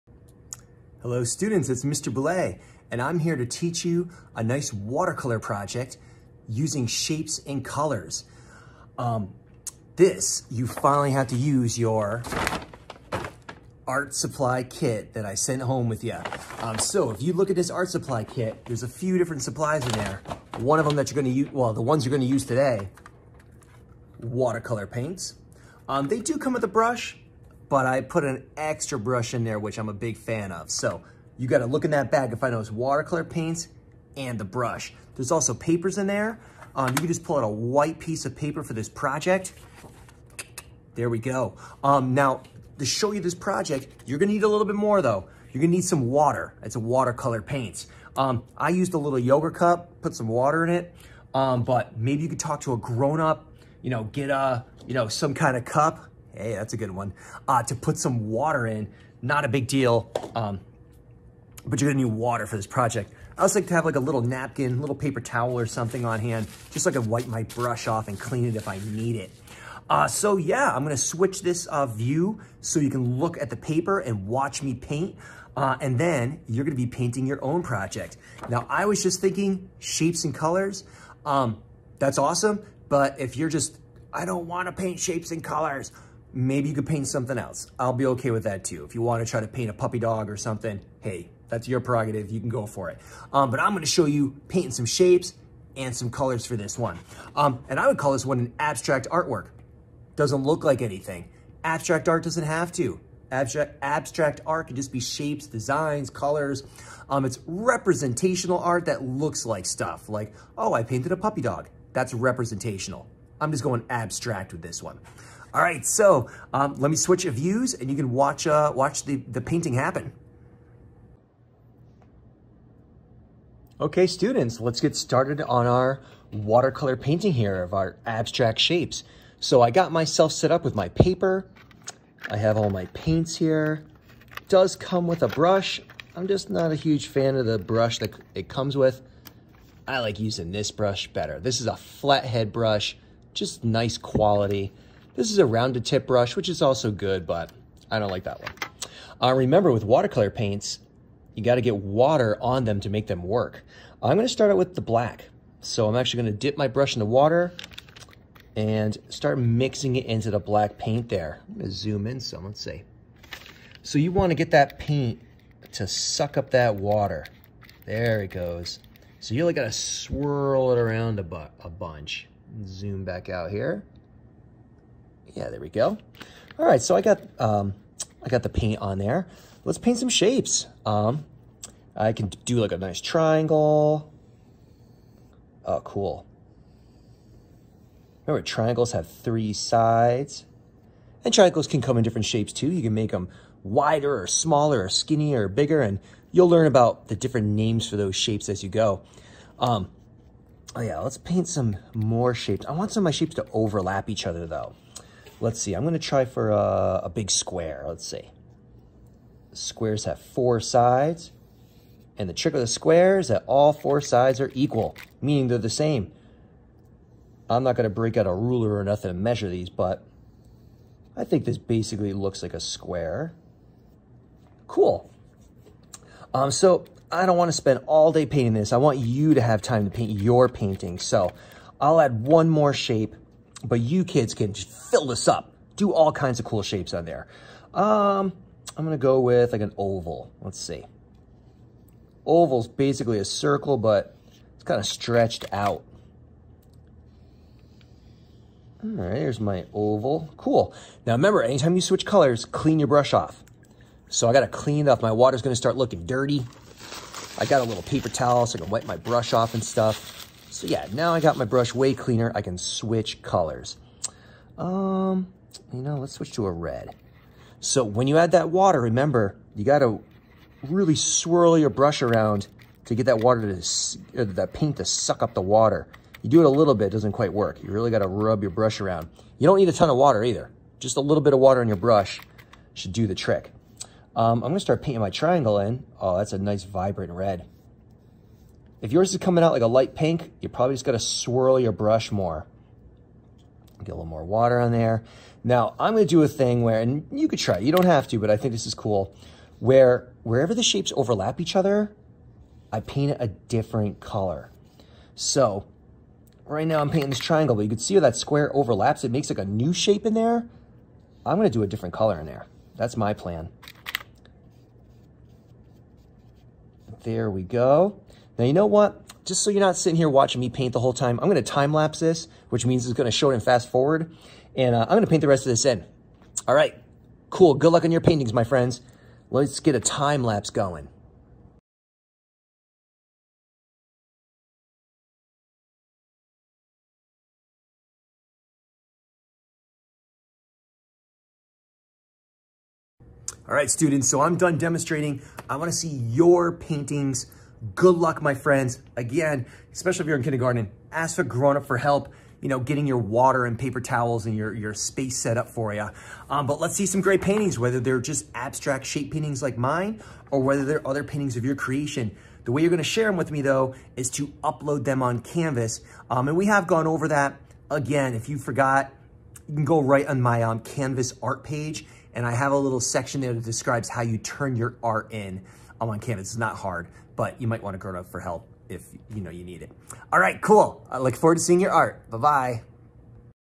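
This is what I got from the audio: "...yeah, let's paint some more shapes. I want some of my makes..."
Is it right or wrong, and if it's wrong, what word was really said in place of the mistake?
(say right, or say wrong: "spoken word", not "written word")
wrong: "shapes", not "makes".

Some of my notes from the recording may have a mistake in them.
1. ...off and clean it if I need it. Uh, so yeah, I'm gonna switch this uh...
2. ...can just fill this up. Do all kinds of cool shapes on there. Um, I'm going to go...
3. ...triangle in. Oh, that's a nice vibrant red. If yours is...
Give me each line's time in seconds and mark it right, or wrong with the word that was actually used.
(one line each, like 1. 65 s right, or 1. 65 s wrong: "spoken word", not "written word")
1. 67 s right
2. 234 s right
3. 285 s right.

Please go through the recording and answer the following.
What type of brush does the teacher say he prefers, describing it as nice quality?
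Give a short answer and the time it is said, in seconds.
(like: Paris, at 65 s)
Flathead brush, at 141 s.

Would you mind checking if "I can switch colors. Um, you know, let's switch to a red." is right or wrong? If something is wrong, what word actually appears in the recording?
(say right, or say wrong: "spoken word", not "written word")
right.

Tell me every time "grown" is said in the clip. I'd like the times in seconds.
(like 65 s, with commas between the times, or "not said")
52 s, 351 s.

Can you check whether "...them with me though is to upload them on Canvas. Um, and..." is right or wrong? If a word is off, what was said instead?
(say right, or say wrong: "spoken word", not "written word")
right.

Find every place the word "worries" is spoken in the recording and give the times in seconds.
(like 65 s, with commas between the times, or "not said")
not said.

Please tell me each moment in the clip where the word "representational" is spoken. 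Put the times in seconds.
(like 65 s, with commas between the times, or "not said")
107 s, 112 s.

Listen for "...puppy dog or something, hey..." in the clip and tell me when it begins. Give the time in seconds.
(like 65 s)
89 s.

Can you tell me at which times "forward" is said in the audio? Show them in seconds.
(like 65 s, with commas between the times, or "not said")
323 s, 381 s.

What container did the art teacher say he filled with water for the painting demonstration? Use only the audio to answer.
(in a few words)
Yogurt cup.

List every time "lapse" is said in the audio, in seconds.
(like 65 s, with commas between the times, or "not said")
321 s, 330 s.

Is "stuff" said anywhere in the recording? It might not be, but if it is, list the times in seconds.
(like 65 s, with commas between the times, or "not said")
109 s, 259 s.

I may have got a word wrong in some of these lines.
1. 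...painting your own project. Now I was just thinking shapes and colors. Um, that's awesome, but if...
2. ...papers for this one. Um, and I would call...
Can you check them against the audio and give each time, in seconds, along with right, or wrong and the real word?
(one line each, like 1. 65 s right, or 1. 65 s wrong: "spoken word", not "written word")
1. 76 s right
2. 96 s wrong: "colors", not "papers".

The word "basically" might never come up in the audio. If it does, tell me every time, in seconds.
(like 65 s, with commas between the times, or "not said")
221 s, 242 s.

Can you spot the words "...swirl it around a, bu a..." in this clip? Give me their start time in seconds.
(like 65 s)
169 s.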